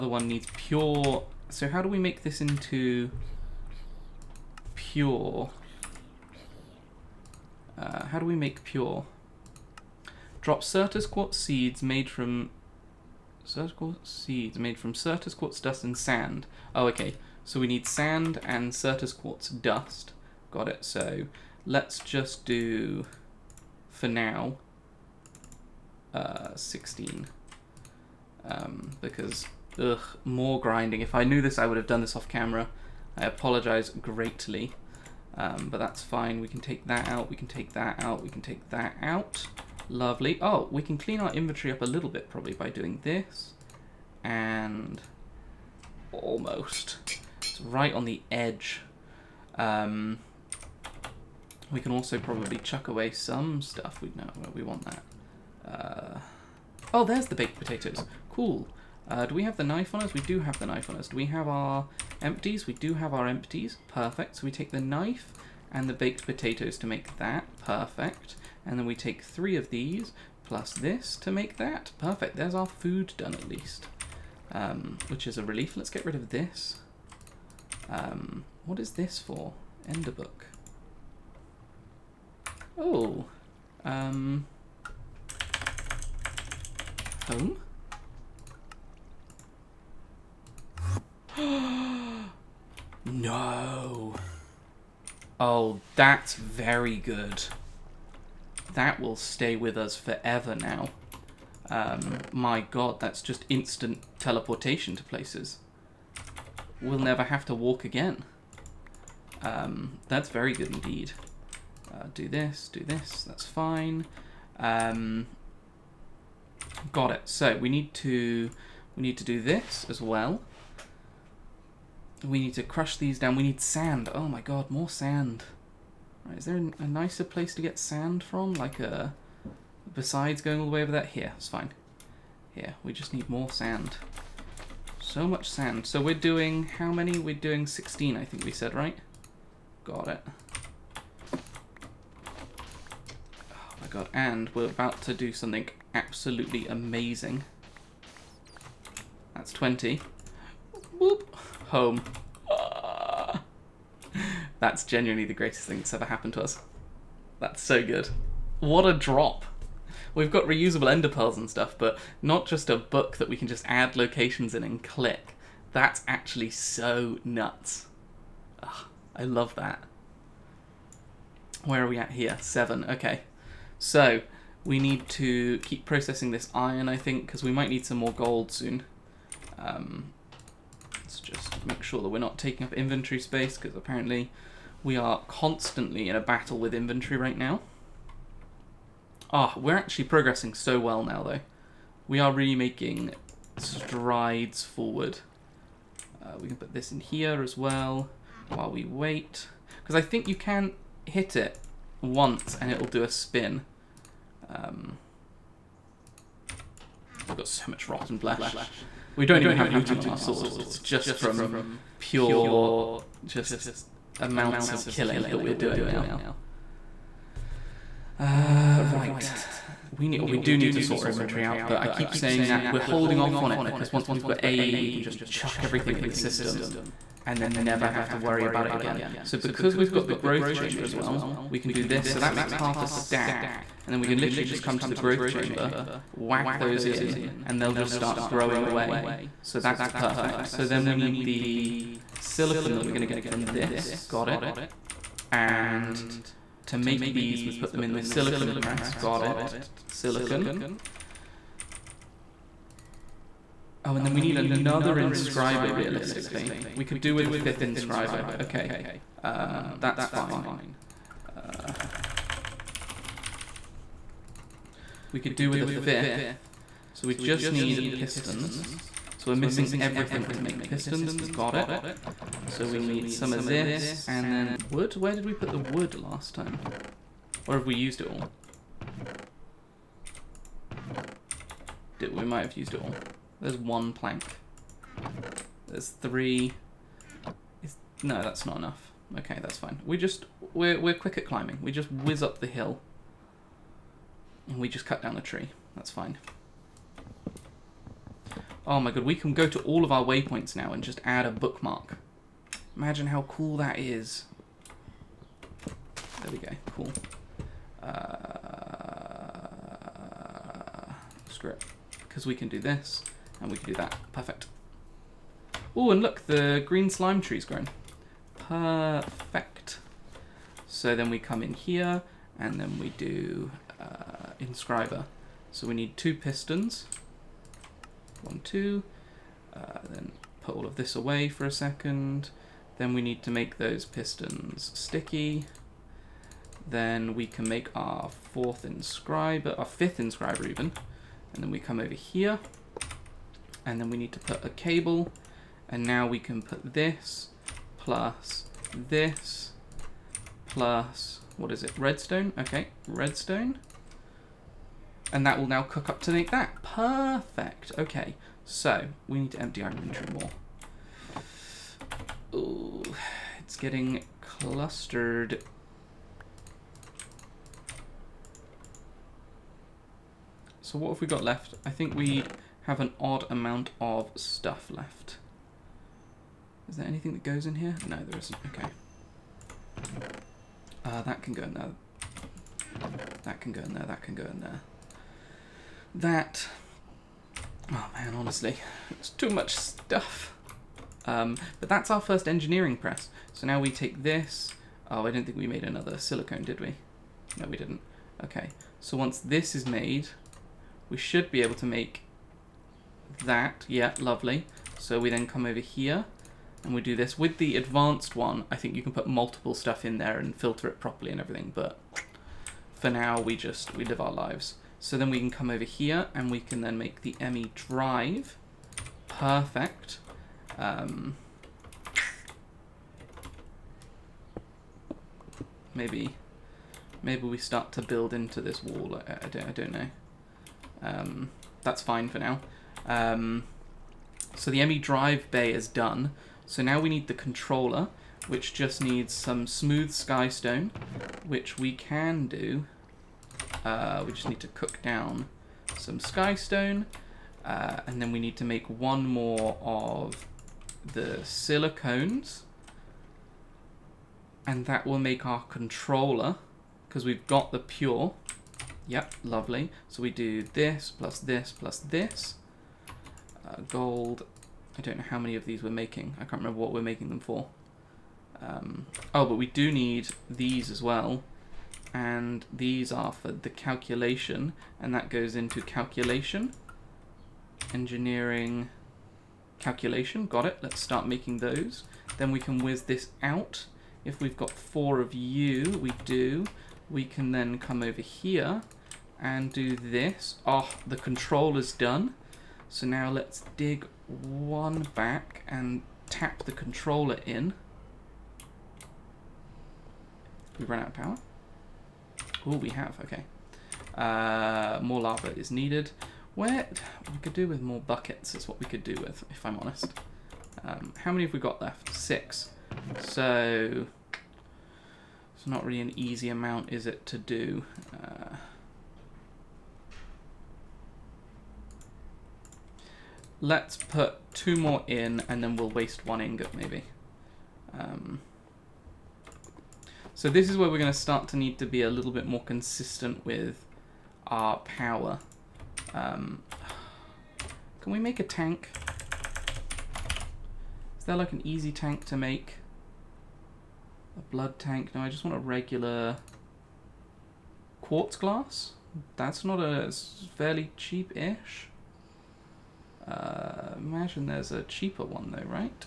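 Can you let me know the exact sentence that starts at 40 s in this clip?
Oh, we can clean our inventory up a little bit probably by doing this.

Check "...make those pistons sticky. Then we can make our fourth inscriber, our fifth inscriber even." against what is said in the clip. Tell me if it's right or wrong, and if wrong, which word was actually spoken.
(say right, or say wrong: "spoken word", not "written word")
right.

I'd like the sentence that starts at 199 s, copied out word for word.
Because I think you can hit it once and it'll do a spin.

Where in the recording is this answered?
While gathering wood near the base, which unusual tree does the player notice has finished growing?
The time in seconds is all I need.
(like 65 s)
316 s.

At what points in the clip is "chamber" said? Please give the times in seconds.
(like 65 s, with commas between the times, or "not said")
230 s, 235 s.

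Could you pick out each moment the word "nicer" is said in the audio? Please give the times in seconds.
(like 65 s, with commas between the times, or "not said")
126 s.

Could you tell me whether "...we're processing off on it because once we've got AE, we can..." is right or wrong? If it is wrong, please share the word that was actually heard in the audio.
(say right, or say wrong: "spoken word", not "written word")
wrong: "holding", not "processing".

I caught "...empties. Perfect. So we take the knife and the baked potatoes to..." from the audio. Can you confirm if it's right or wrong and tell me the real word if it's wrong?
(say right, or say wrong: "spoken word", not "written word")
right.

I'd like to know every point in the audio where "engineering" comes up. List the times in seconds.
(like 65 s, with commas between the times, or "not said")
392 s, 477 s.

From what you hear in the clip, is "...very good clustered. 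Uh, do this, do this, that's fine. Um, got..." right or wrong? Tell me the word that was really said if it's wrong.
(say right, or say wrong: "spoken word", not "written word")
wrong: "indeed", not "clustered".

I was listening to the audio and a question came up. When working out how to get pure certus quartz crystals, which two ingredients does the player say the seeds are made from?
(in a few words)
Sand and certus quartz dust.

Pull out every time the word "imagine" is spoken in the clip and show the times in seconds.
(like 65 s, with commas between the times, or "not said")
302 s, 553 s.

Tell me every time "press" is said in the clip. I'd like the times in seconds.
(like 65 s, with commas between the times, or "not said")
248 s, 392 s.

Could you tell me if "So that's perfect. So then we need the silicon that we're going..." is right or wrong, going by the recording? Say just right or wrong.
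right.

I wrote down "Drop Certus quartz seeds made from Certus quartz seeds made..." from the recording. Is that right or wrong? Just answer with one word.
right.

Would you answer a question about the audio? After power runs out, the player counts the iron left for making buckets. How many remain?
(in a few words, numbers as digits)
6.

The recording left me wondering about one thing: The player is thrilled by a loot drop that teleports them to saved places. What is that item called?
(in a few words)
Ender book.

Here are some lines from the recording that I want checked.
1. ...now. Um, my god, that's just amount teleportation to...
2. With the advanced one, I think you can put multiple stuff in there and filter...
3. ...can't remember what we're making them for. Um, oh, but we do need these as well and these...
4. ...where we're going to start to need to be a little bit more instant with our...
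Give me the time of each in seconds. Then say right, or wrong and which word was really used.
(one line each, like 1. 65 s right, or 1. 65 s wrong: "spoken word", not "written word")
1. 100 s wrong: "instant", not "amount"
2. 407 s right
3. 466 s right
4. 530 s wrong: "consistent", not "instant".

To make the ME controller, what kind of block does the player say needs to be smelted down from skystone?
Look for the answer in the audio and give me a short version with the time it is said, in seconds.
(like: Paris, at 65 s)
Smooth sky stone, at 439 s.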